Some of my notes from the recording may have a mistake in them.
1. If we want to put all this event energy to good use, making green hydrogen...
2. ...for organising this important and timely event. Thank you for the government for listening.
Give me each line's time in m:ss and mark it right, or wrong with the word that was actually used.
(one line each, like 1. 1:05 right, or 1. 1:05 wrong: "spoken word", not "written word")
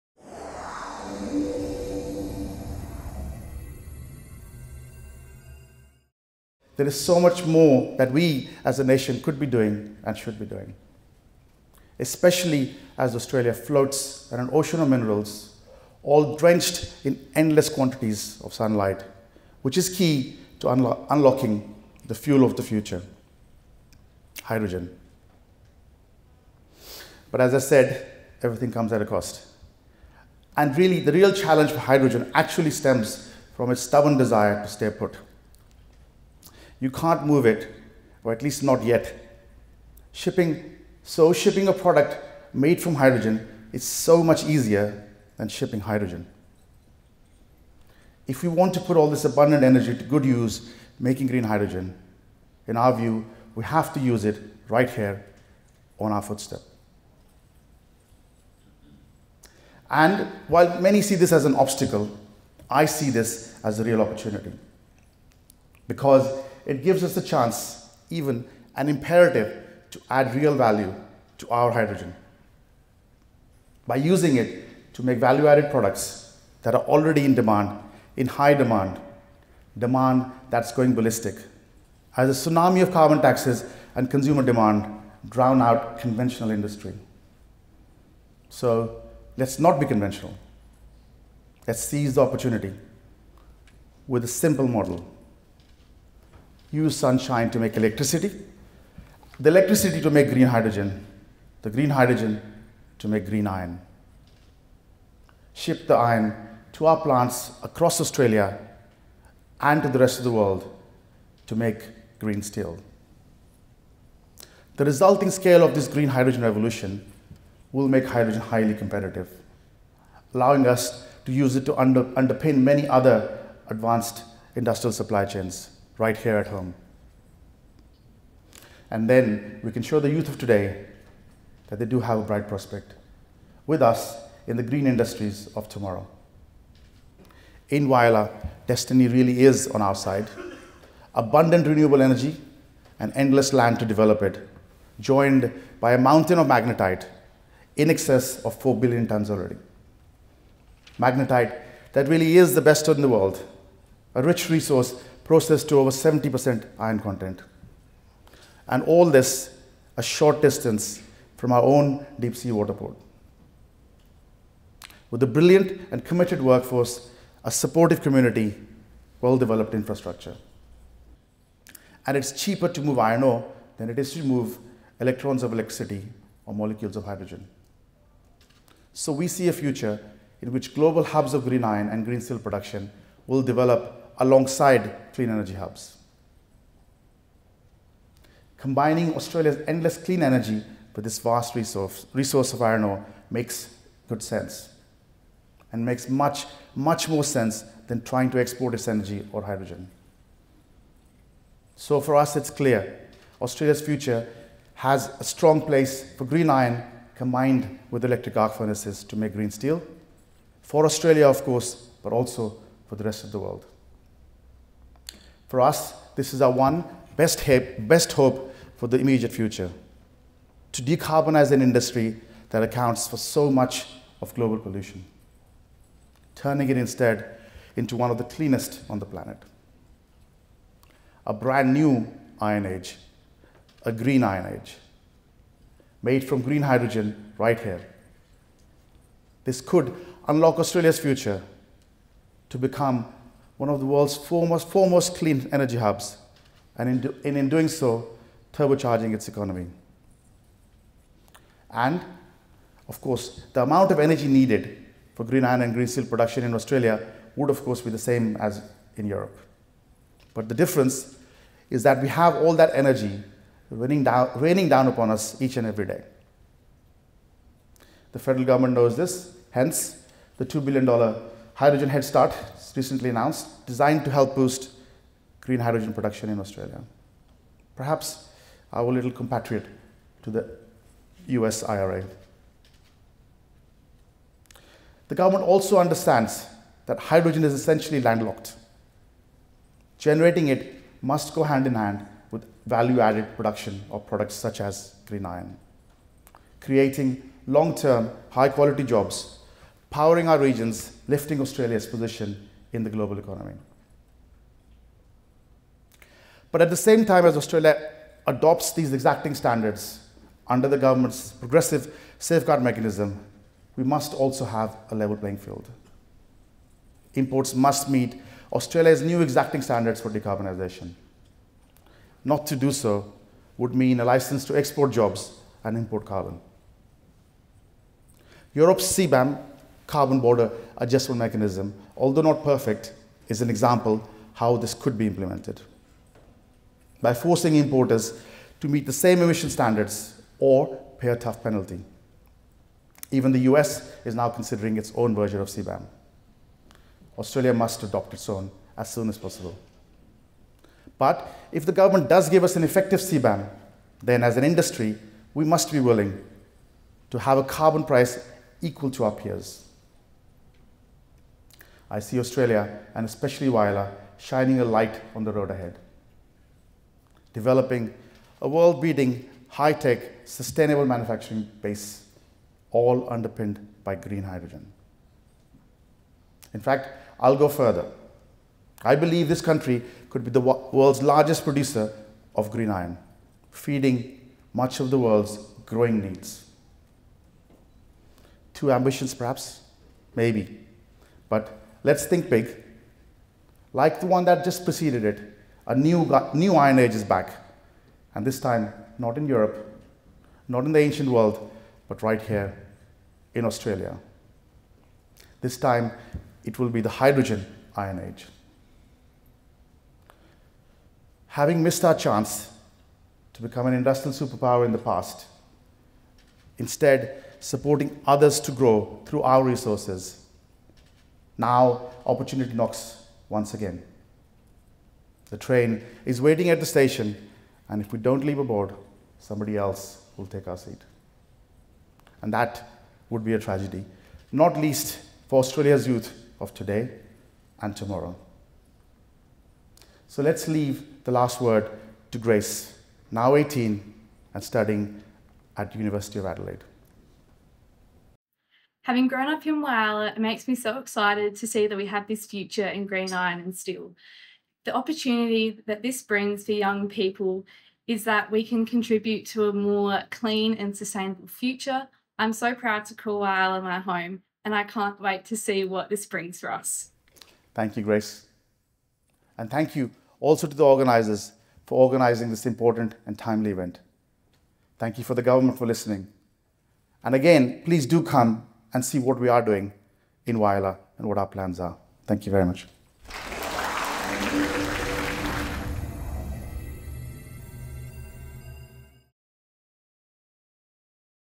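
1. 0:48 wrong: "abundant", not "event"
2. 7:51 right.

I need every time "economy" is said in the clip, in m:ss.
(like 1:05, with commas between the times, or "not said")
4:09, 5:03.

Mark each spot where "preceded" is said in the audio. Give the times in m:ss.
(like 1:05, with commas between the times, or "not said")
6:34.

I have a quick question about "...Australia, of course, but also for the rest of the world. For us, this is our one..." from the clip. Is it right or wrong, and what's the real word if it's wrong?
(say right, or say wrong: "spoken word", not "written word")
right.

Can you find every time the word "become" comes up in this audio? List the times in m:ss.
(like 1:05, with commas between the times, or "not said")
4:02, 6:53.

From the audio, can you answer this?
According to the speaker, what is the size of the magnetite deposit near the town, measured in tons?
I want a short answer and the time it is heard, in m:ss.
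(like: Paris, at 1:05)
4 billion tons, at 2:28.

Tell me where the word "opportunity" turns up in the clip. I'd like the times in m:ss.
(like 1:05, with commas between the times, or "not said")
1:04, 1:32, 7:02, 7:34.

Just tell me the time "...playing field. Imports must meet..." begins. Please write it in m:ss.
5:15.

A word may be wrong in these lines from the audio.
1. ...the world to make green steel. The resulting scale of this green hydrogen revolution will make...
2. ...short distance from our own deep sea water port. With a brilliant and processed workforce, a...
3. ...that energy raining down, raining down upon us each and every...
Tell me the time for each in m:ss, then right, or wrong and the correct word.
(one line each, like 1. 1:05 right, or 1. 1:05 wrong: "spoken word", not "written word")
1. 1:50 right
2. 2:40 wrong: "committed", not "processed"
3. 4:22 right.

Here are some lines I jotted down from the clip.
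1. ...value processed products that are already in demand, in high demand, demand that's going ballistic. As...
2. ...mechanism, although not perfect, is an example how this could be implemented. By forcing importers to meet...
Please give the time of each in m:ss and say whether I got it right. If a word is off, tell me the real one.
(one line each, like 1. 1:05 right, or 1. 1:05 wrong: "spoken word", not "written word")
1. 1:15 wrong: "added", not "processed"
2. 5:31 right.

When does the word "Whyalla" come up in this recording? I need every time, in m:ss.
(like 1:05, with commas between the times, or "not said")
2:17, 6:03, 7:29, 7:43, 8:00.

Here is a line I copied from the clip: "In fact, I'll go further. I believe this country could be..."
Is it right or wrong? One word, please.
right.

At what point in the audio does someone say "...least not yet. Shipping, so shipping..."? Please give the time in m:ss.
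0:38.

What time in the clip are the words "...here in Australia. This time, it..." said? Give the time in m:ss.
6:42.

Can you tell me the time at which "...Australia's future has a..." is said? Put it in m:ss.
3:23.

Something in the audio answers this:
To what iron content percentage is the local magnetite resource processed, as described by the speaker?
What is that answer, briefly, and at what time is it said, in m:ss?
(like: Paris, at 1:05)
over 70%, at 2:35.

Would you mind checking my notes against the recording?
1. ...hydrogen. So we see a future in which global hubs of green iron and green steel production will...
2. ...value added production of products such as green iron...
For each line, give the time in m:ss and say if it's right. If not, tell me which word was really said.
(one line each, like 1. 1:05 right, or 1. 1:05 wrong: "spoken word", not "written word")
1. 2:57 right
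2. 4:52 right.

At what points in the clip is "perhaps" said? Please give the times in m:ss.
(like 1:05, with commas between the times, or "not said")
4:37, 6:29.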